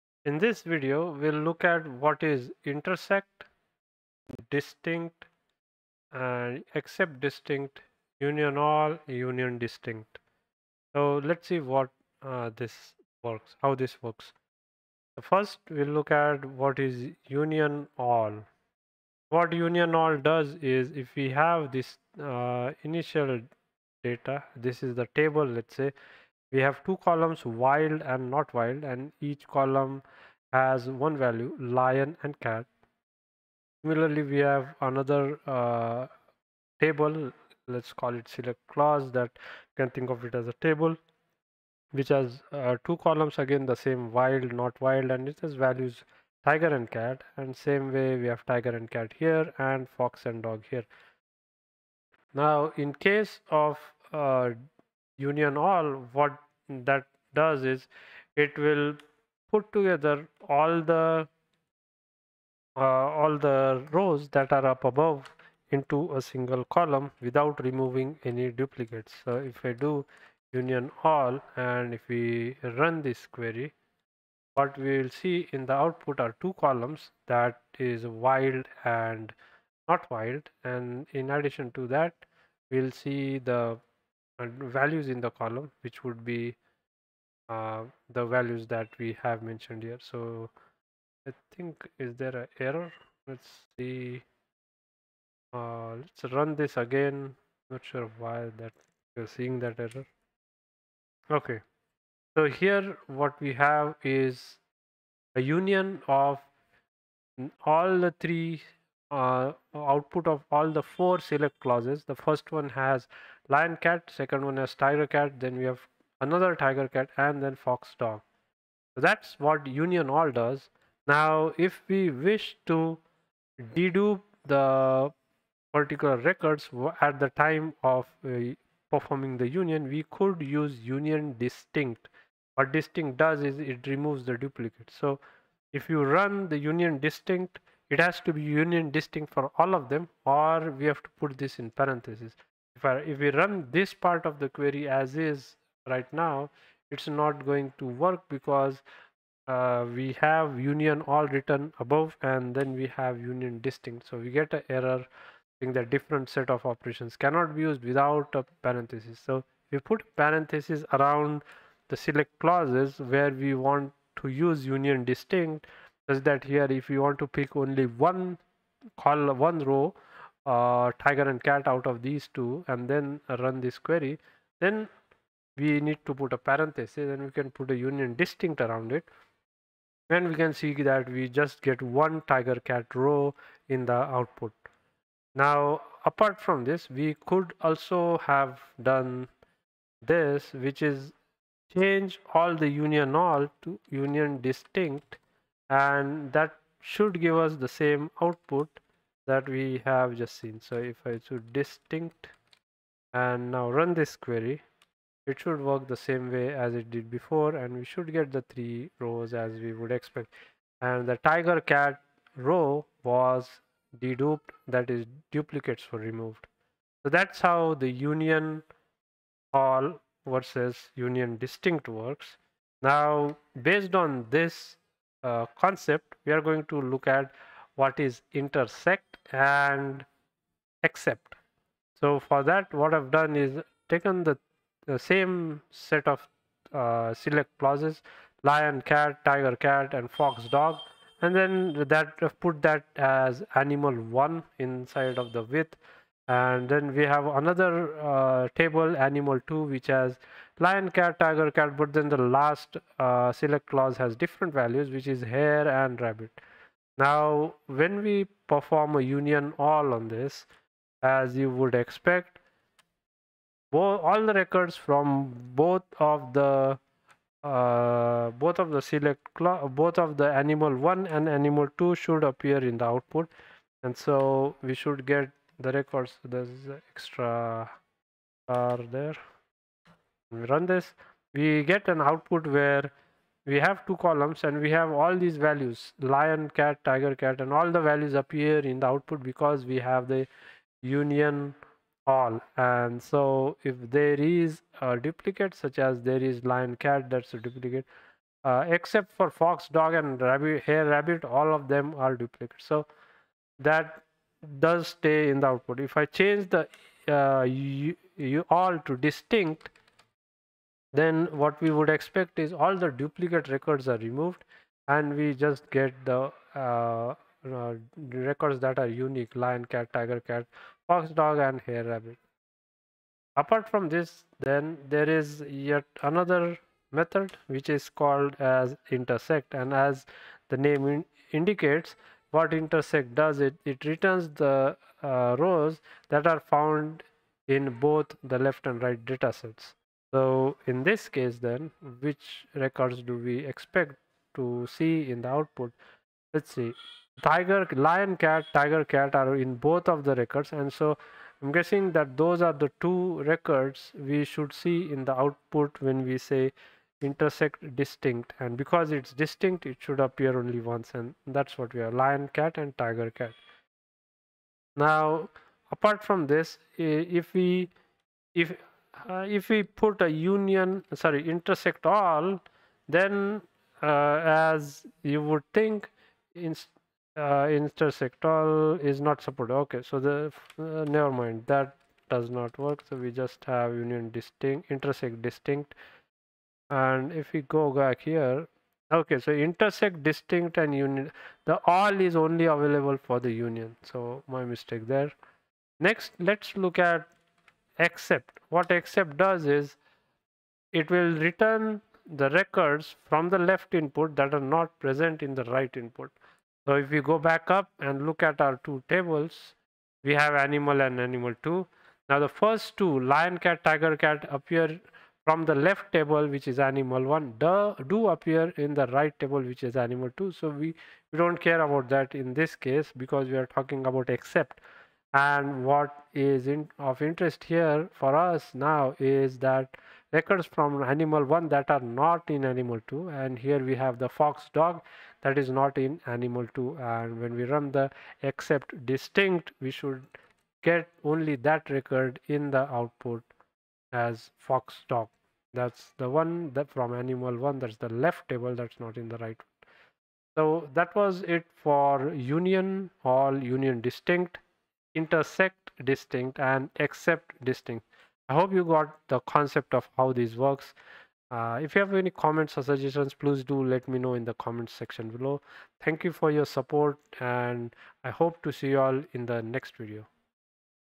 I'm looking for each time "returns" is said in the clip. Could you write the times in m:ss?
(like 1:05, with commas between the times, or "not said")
5:33, 6:41.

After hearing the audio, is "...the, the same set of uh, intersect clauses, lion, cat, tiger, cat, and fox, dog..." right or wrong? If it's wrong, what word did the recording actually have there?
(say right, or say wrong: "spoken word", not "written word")
wrong: "select", not "intersect".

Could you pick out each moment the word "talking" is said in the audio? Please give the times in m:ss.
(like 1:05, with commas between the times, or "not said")
7:03.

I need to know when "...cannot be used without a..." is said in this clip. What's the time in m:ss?
2:37.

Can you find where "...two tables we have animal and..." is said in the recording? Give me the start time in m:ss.
6:48.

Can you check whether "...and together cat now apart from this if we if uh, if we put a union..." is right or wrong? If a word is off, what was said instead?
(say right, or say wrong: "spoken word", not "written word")
wrong: "tiger", not "together".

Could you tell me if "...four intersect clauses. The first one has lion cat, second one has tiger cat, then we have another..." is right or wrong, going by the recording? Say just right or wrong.
wrong.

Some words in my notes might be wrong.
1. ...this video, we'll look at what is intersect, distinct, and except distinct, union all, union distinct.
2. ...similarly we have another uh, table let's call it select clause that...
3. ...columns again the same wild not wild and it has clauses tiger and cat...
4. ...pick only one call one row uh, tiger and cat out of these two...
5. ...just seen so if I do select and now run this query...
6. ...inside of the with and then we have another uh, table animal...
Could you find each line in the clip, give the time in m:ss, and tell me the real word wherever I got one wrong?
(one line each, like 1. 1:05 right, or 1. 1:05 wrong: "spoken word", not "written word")
1. 0:00 right
2. 0:33 right
3. 0:42 wrong: "values", not "clauses"
4. 2:47 right
5. 3:20 wrong: "distinct", not "select"
6. 4:04 right.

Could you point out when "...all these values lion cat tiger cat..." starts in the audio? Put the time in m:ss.
4:44.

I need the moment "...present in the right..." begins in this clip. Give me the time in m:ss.
6:44.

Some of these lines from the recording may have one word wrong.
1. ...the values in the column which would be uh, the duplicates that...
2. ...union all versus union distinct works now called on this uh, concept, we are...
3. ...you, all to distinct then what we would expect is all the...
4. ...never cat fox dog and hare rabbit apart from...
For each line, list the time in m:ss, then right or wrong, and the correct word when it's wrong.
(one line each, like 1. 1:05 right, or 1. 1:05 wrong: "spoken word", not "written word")
1. 1:23 wrong: "values", not "duplicates"
2. 3:38 wrong: "based", not "called"
3. 5:07 right
4. 5:19 wrong: "tiger", not "never".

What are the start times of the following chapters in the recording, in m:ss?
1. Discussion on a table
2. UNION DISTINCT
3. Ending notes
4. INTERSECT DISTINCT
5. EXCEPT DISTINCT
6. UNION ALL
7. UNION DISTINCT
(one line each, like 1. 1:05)
1. 3:52
2. 2:05
3. 7:30
4. 5:26
5. 6:39
6. 4:34
7. 5:05.